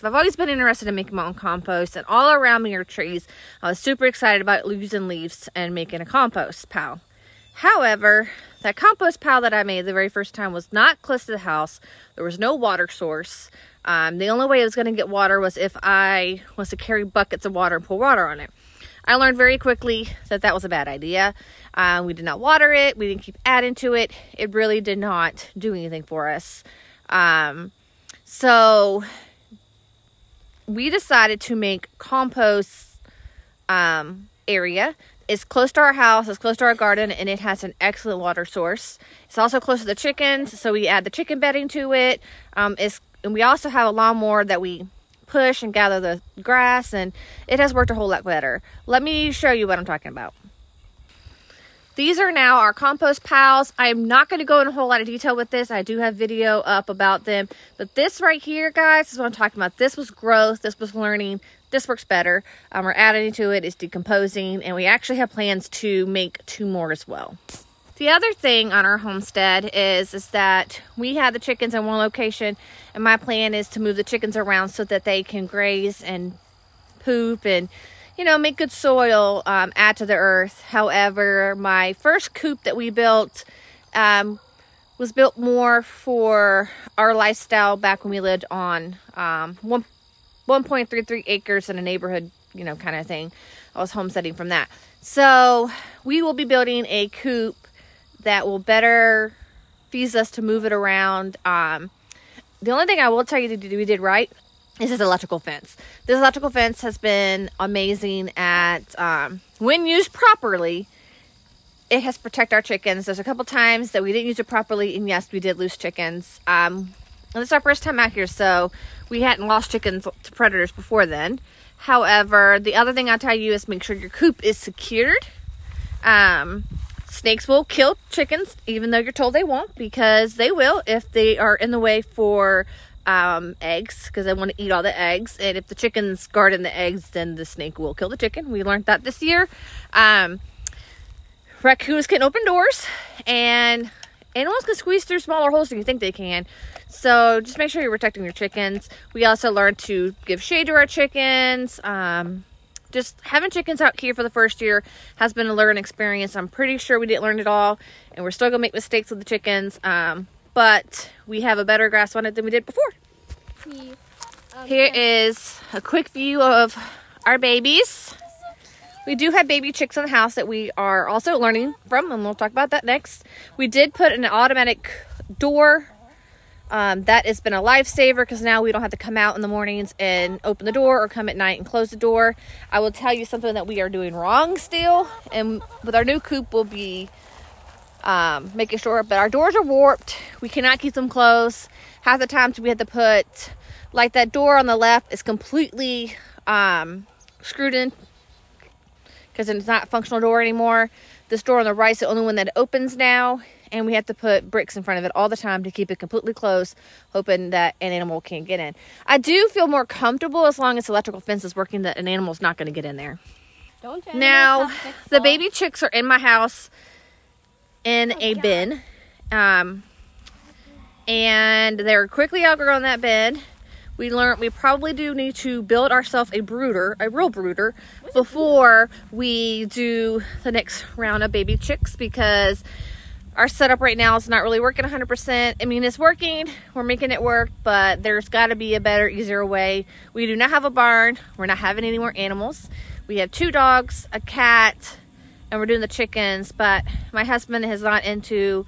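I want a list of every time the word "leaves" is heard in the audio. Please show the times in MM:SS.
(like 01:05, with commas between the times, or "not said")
00:05.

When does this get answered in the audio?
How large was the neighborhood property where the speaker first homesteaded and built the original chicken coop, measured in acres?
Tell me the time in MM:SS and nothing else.
01:30.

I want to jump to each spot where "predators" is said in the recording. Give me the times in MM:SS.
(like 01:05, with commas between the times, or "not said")
02:00.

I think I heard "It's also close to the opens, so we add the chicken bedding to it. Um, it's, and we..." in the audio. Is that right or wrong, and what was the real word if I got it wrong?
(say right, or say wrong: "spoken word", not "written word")
wrong: "chickens", not "opens".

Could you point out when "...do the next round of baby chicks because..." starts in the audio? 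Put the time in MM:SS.
03:49.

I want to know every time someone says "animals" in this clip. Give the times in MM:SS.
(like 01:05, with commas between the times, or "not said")
02:24, 03:27, 03:32, 04:02.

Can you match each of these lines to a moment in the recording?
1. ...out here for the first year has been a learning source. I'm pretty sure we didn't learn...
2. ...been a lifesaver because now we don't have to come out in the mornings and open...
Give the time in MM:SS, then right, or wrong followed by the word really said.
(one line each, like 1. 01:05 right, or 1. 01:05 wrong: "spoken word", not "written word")
1. 02:33 wrong: "experience", not "source"
2. 02:57 right.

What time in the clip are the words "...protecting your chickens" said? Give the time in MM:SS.
02:27.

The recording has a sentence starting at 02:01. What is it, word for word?
However, the other thing I tell you is make sure your coop is secured.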